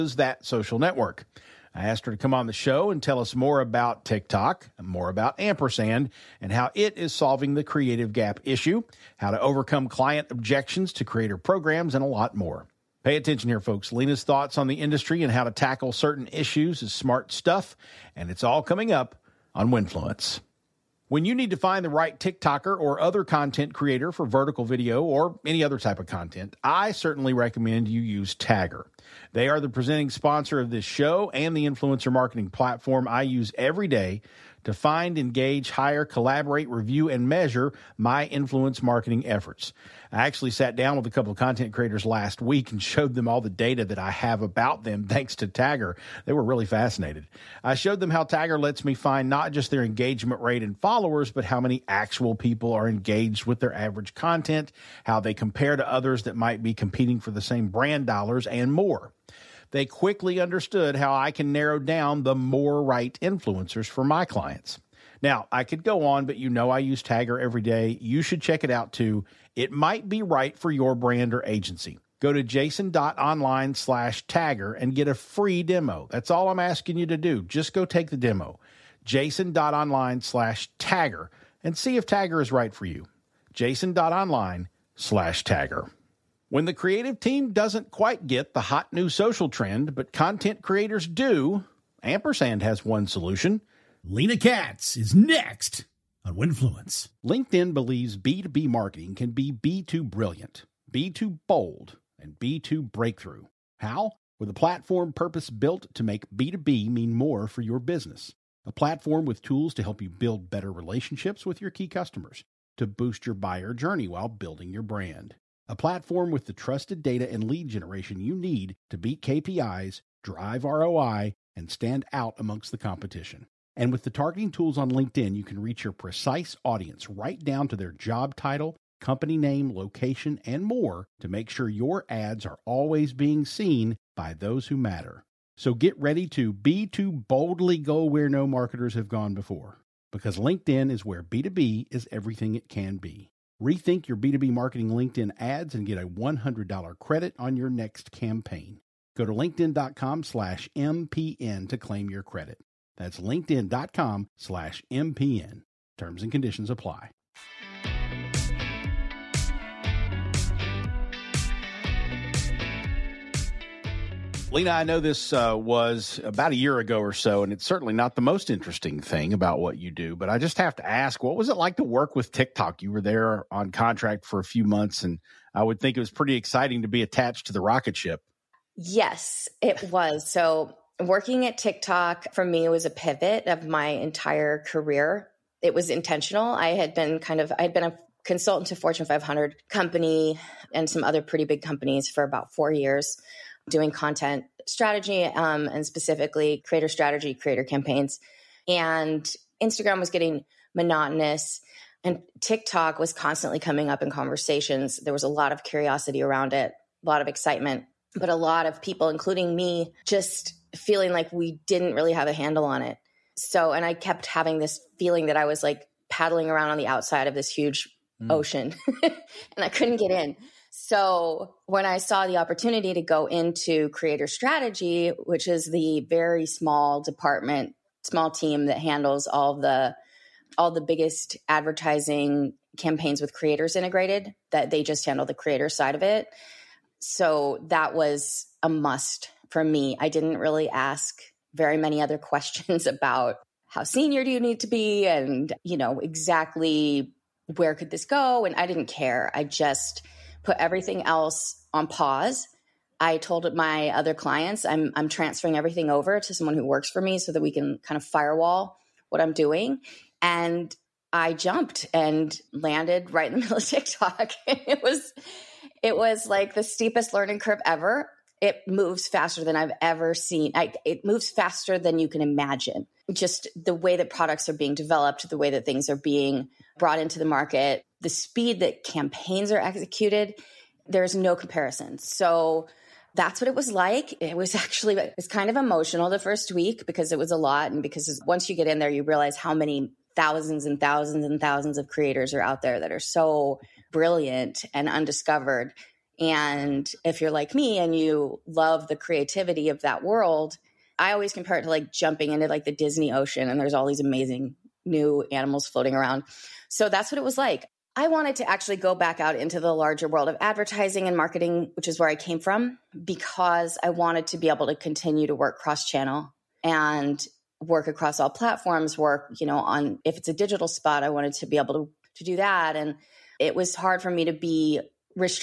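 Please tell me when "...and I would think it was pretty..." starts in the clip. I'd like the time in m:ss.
2:55.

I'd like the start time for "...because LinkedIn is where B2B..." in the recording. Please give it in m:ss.
2:20.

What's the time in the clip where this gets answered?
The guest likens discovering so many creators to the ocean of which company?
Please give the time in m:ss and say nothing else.
5:02.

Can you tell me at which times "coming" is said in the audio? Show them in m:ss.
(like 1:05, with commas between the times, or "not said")
0:18, 3:23.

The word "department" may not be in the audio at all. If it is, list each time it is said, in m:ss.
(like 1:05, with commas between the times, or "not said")
3:47.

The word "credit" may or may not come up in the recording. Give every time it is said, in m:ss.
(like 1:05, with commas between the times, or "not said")
2:26, 2:32.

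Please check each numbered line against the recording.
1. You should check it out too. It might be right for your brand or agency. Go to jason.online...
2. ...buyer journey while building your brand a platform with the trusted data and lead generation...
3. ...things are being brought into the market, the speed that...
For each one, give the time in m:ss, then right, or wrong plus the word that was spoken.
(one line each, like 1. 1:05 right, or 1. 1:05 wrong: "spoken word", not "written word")
1. 1:07 right
2. 1:53 right
3. 4:35 right.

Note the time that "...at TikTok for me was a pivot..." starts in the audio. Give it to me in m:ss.
3:01.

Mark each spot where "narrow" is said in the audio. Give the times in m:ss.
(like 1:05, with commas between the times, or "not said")
1:01.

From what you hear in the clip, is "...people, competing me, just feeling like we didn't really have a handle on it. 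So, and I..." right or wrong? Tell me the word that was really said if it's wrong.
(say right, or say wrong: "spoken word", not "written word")
wrong: "including", not "competing".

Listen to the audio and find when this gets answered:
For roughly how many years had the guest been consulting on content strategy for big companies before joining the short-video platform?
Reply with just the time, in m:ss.
3:12.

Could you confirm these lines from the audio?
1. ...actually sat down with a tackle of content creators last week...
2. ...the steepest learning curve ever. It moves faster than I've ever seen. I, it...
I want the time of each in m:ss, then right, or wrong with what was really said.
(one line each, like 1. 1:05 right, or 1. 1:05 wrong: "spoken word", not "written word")
1. 0:40 wrong: "couple", not "tackle"
2. 4:26 right.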